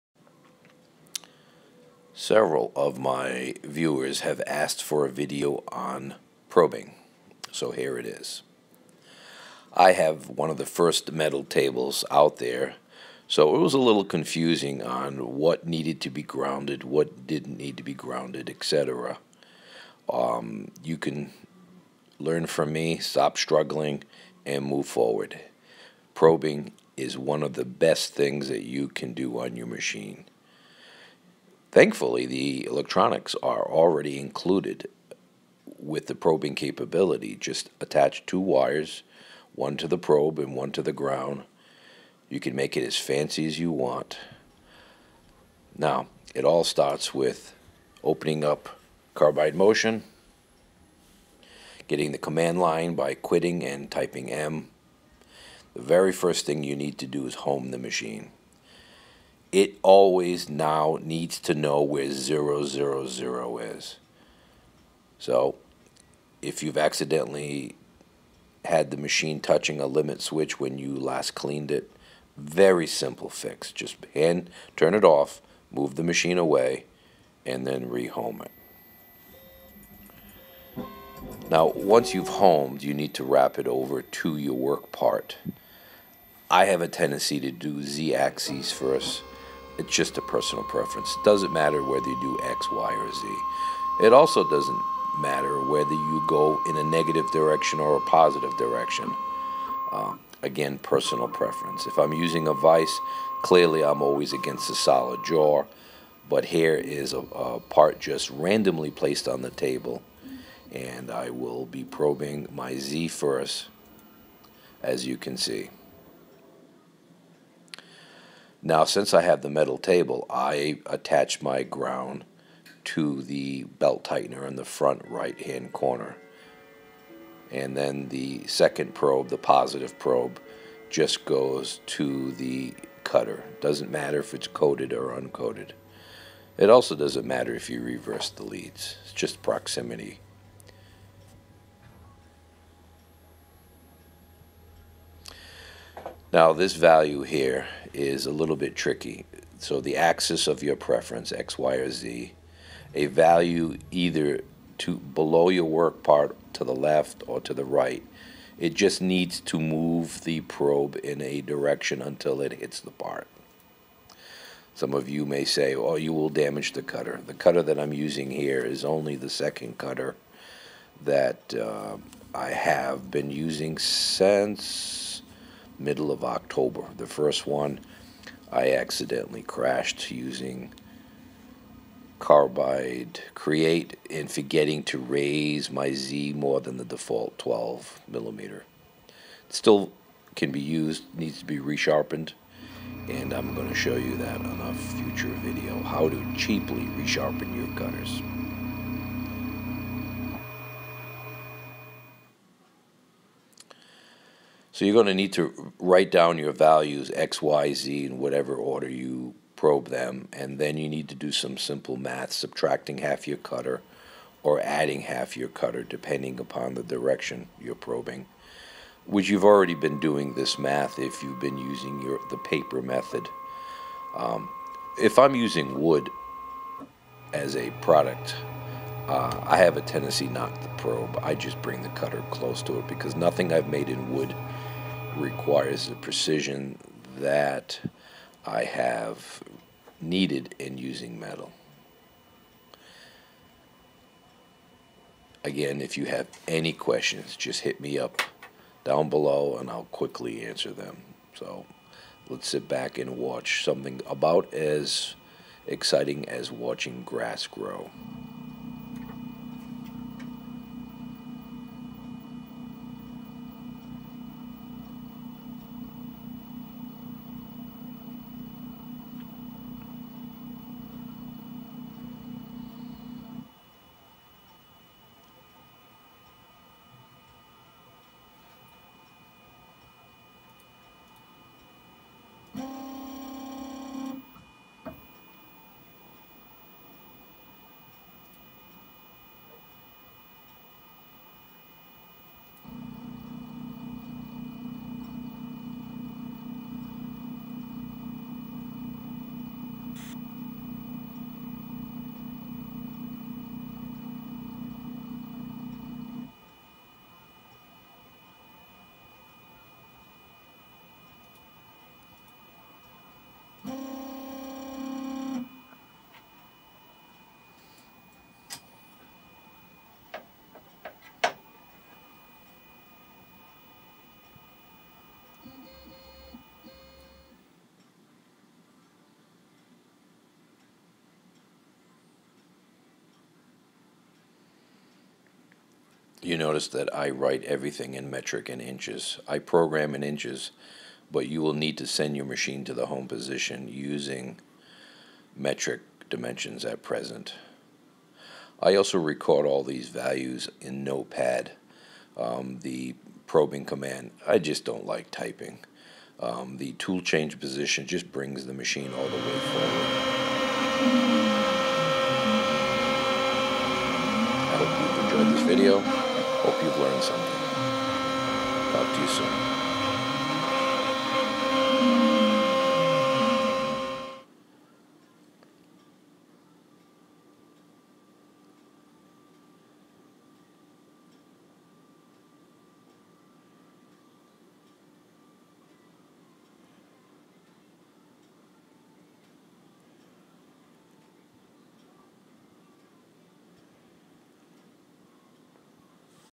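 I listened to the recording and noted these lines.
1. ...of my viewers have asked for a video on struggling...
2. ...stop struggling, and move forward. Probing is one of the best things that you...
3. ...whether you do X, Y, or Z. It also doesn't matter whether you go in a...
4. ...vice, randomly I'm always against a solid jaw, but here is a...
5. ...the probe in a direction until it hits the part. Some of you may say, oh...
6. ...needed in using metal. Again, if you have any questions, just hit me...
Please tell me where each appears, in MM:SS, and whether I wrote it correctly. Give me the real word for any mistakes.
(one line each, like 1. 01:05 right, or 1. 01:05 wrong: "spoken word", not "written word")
1. 00:02 wrong: "probing", not "struggling"
2. 00:22 right
3. 01:31 right
4. 01:42 wrong: "clearly", not "randomly"
5. 02:40 right
6. 03:59 right.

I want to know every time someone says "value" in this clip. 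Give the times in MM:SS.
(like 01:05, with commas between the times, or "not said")
02:26, 02:33, 03:26, 05:49.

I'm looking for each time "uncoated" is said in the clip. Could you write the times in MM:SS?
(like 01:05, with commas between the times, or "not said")
02:15.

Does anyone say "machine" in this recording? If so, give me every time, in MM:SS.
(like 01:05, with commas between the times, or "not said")
00:29, 00:57, 01:08, 01:16, 05:42, 05:58.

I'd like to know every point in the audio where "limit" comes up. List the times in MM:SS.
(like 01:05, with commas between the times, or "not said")
01:09.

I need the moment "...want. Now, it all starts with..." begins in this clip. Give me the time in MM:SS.
00:43.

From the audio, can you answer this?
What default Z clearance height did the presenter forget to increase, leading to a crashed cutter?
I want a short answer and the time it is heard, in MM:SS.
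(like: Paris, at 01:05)
12 millimeter, at 03:07.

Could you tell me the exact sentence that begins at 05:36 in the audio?
You notice that I write everything in metric and inches.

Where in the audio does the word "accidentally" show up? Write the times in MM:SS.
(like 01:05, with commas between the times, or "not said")
01:06, 02:58.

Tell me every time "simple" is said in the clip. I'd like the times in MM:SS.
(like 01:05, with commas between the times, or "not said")
01:12, 03:31.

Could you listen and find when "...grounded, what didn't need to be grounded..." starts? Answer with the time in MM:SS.
00:16.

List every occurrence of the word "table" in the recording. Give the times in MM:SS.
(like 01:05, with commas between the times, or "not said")
00:11, 01:49, 01:59.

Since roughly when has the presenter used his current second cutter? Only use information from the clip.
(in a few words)
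middle of October.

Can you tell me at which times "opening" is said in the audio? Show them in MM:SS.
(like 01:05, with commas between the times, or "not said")
00:48.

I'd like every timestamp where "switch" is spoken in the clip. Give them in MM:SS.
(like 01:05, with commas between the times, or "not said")
01:10.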